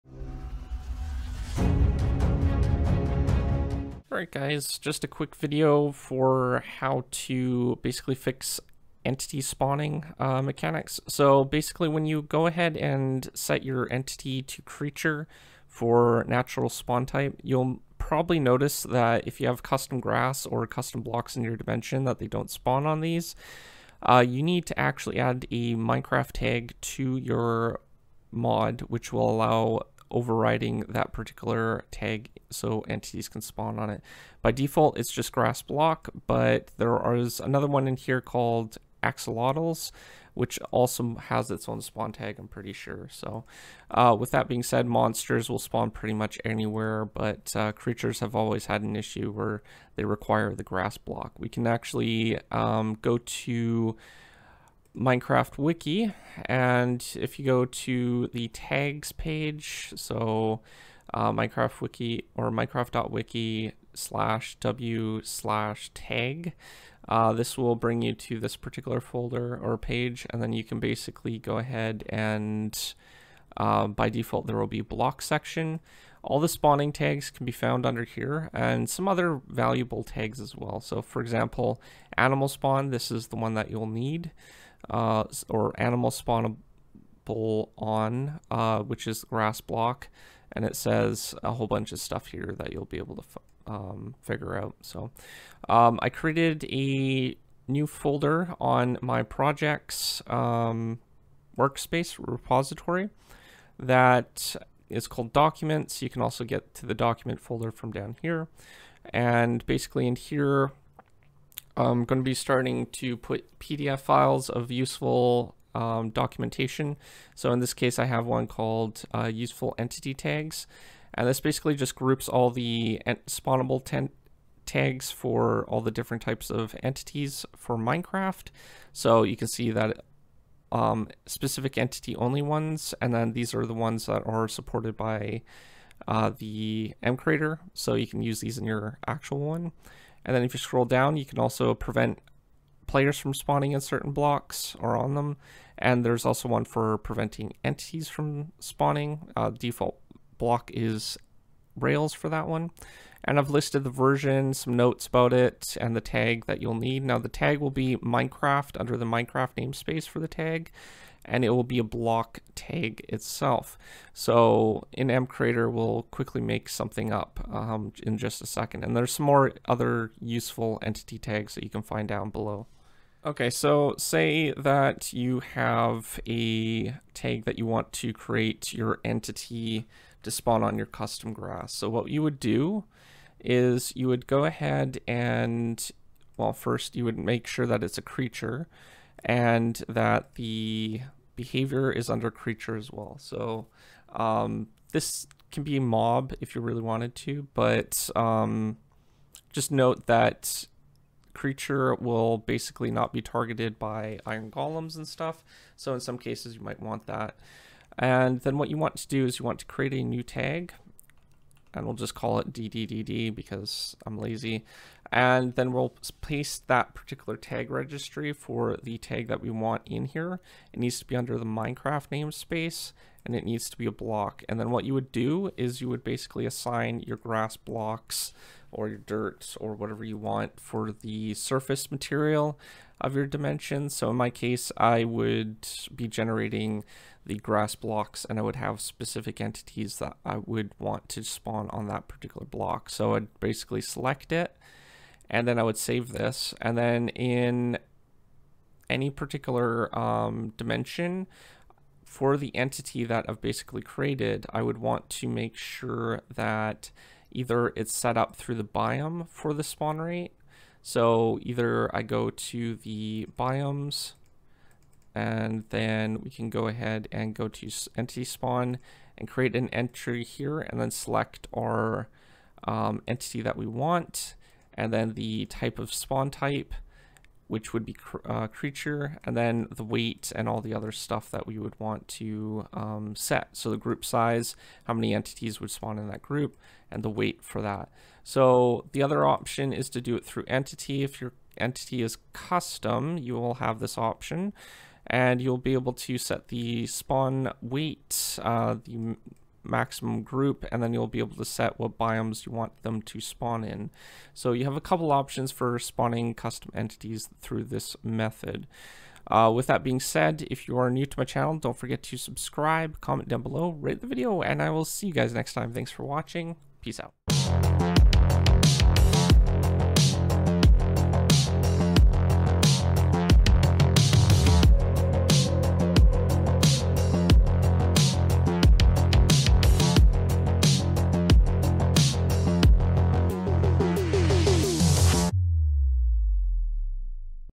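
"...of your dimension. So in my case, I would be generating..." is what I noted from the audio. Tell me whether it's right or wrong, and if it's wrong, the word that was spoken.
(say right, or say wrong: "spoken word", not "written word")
right.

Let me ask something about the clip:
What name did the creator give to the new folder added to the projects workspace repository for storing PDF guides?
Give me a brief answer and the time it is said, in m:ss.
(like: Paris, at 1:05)
documents, at 1:45.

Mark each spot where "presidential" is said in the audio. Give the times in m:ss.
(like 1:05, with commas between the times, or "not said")
not said.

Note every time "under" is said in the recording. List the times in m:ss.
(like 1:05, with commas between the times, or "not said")
1:17, 2:38, 3:12, 3:41.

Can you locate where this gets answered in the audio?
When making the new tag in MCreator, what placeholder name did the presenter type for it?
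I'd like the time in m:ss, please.
3:32.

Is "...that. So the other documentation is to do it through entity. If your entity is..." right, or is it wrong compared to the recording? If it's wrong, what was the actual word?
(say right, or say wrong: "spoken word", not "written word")
wrong: "option", not "documentation".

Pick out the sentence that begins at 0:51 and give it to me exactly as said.
We can actually um, go to Minecraft wiki.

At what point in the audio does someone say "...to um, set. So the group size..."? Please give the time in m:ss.
4:42.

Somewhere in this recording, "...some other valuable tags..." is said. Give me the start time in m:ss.
1:18.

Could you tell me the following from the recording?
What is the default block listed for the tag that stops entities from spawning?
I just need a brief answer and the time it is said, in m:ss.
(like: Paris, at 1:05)
Rails, at 2:31.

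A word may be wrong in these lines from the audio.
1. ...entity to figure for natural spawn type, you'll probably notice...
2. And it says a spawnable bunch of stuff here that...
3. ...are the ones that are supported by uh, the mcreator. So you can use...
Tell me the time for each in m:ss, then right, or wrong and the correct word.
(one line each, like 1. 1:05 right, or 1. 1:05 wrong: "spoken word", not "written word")
1. 0:13 wrong: "creature", not "figure"
2. 1:30 wrong: "whole", not "spawnable"
3. 2:13 right.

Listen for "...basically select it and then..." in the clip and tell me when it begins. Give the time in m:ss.
4:03.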